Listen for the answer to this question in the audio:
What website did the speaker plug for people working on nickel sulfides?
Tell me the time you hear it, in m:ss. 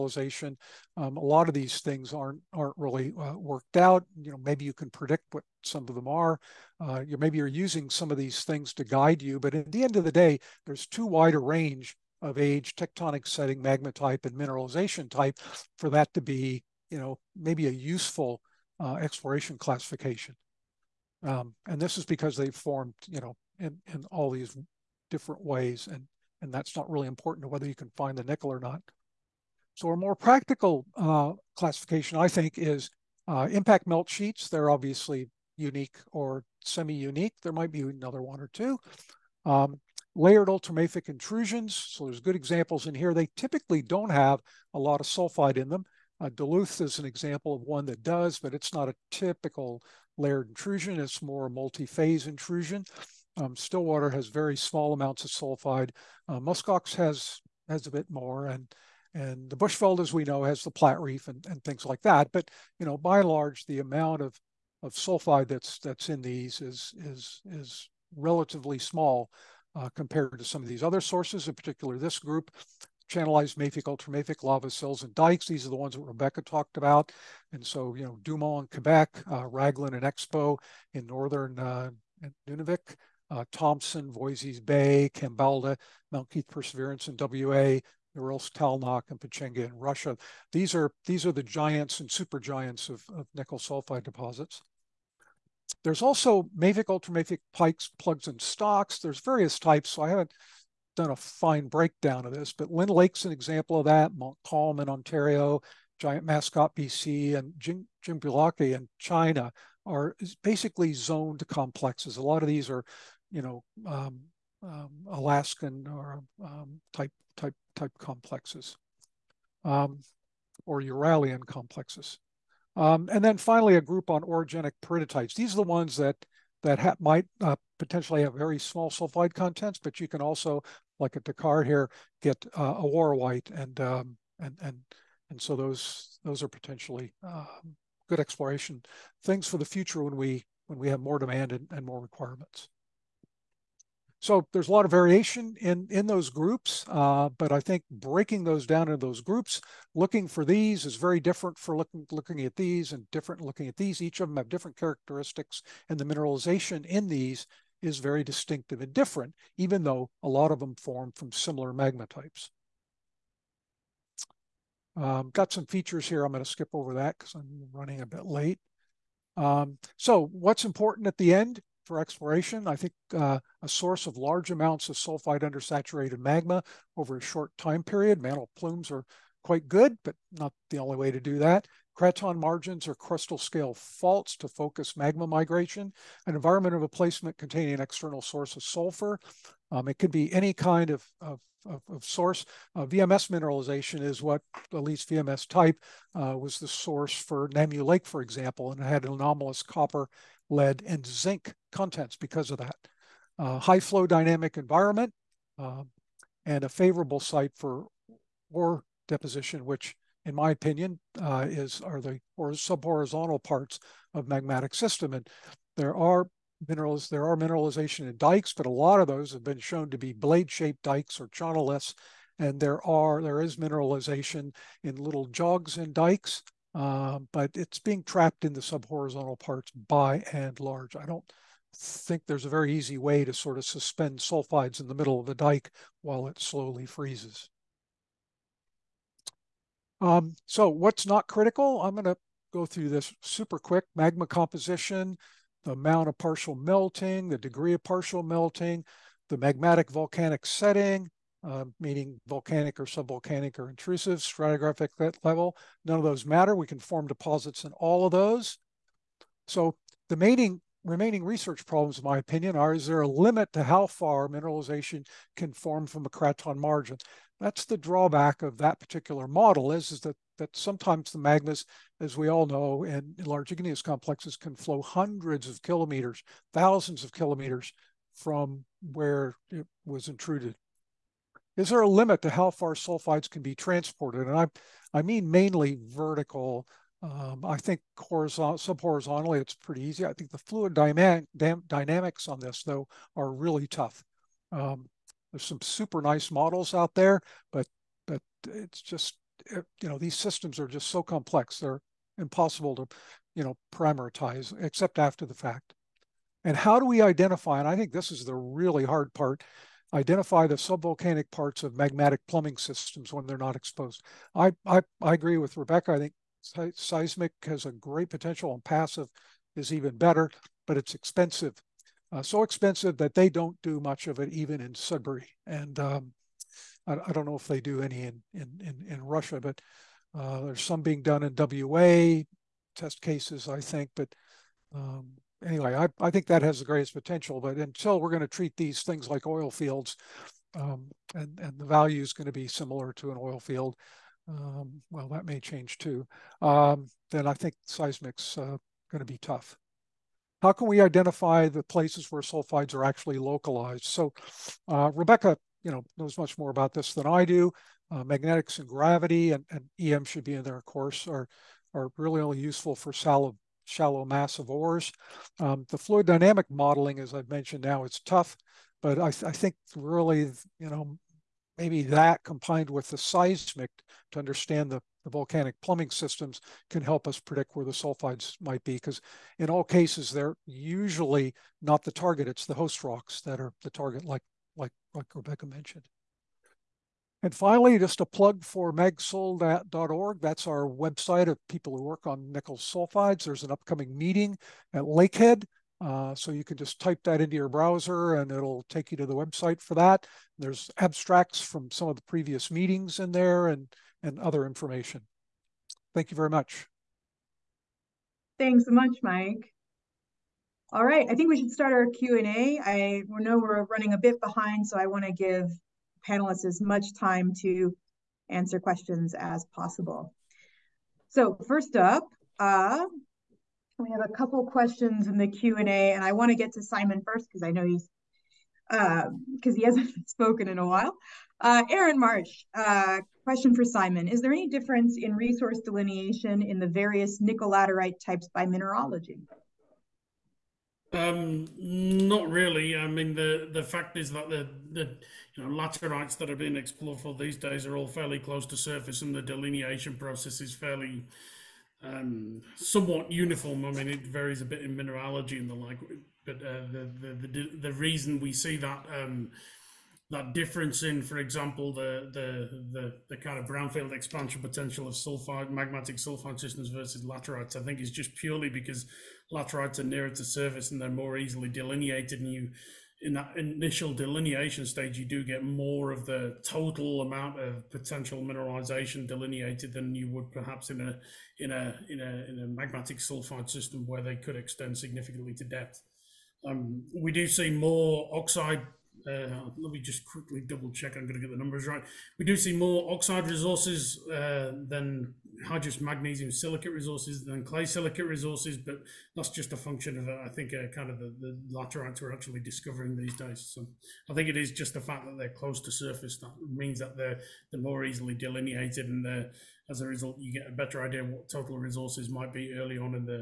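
6:28.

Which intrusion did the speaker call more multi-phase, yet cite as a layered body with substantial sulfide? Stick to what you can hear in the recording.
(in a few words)
Duluth.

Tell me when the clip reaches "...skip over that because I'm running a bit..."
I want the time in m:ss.
2:46.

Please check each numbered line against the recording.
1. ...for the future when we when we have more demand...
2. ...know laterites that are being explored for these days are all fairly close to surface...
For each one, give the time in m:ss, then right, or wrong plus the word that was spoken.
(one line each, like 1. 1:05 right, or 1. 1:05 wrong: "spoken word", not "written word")
1. 2:19 right
2. 7:25 right.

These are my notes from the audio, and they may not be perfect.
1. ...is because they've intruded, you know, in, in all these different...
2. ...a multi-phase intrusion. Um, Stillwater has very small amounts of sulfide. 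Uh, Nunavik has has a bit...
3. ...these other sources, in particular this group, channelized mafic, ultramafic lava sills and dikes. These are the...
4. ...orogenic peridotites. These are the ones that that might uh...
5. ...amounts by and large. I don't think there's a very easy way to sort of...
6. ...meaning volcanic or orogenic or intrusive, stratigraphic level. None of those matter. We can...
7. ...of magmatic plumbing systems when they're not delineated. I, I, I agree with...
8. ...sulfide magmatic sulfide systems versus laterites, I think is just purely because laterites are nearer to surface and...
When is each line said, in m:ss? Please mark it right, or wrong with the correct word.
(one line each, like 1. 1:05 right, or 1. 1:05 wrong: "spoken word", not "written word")
1. 0:21 wrong: "formed", not "intruded"
2. 0:51 wrong: "Muskox", not "Nunavik"
3. 1:10 right
4. 2:04 right
5. 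3:49 wrong: "parts", not "amounts"
6. 4:11 wrong: "subvolcanic", not "orogenic"
7. 5:11 wrong: "exposed", not "delineated"
8. 7:44 right.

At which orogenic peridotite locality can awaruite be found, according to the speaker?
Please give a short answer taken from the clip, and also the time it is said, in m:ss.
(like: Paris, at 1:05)
Decar, at 2:11.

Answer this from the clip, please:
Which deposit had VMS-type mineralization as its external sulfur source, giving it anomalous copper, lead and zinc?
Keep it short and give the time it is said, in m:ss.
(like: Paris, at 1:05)
Namew Lake, at 3:17.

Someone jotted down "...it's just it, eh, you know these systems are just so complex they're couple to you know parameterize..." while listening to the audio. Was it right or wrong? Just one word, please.
wrong.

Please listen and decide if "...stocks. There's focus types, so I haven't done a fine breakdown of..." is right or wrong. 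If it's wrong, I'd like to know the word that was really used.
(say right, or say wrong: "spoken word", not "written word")
wrong: "various", not "focus".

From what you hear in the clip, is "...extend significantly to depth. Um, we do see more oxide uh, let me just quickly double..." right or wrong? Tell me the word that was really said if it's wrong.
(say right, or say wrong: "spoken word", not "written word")
right.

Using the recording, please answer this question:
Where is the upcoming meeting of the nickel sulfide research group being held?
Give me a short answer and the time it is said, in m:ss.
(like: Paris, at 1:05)
Lakehead, at 6:34.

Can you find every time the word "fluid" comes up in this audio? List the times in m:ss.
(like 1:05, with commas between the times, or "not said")
4:50, 6:05.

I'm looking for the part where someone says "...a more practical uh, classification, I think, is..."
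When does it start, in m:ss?
0:29.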